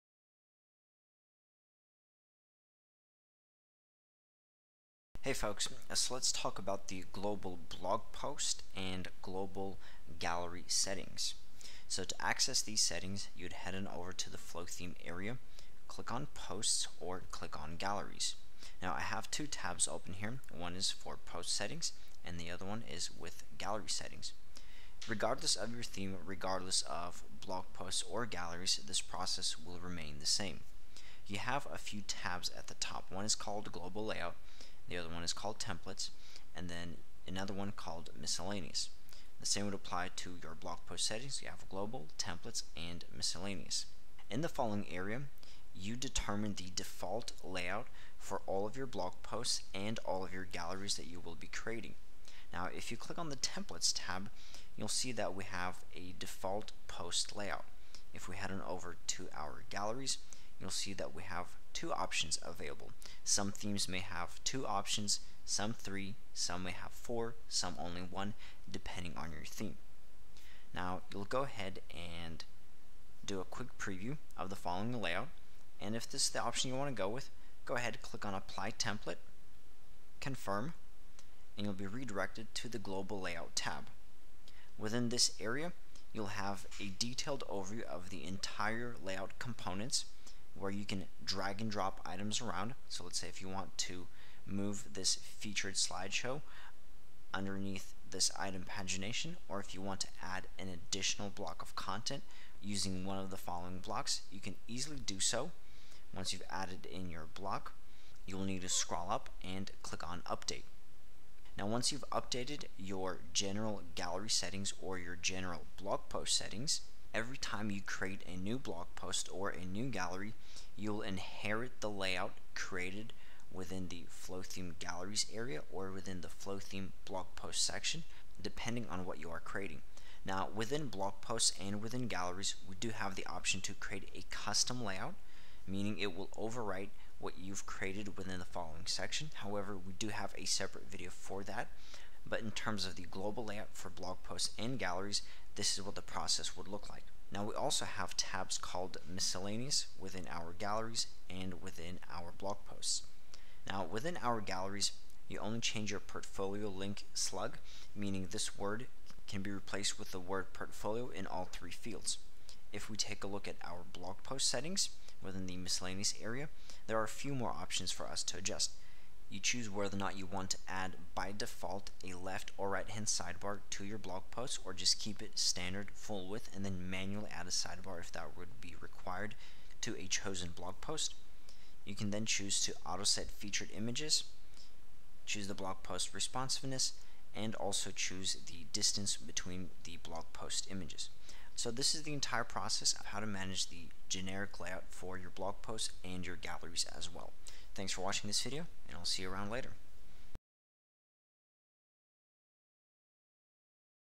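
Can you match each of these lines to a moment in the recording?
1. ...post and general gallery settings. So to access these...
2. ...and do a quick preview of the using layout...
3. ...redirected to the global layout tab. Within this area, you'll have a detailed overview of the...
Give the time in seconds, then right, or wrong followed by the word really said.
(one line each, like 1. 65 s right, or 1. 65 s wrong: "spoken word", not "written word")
1. 8 s wrong: "global", not "general"
2. 71 s wrong: "following", not "using"
3. 81 s right.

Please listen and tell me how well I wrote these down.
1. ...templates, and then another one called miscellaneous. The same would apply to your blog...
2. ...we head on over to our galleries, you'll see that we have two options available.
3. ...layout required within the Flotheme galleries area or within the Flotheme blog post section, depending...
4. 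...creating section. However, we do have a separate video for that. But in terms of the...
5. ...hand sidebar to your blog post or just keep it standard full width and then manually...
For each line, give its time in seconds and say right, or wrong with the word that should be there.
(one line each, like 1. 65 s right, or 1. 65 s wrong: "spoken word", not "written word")
1. 35 s right
2. 58 s right
3. 121 s wrong: "created", not "required"
4. 138 s wrong: "following", not "creating"
5. 172 s right.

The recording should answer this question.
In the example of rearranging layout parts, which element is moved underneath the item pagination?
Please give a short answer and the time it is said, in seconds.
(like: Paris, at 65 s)
Featured slideshow, at 95 s.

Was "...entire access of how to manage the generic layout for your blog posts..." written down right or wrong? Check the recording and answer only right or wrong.
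wrong.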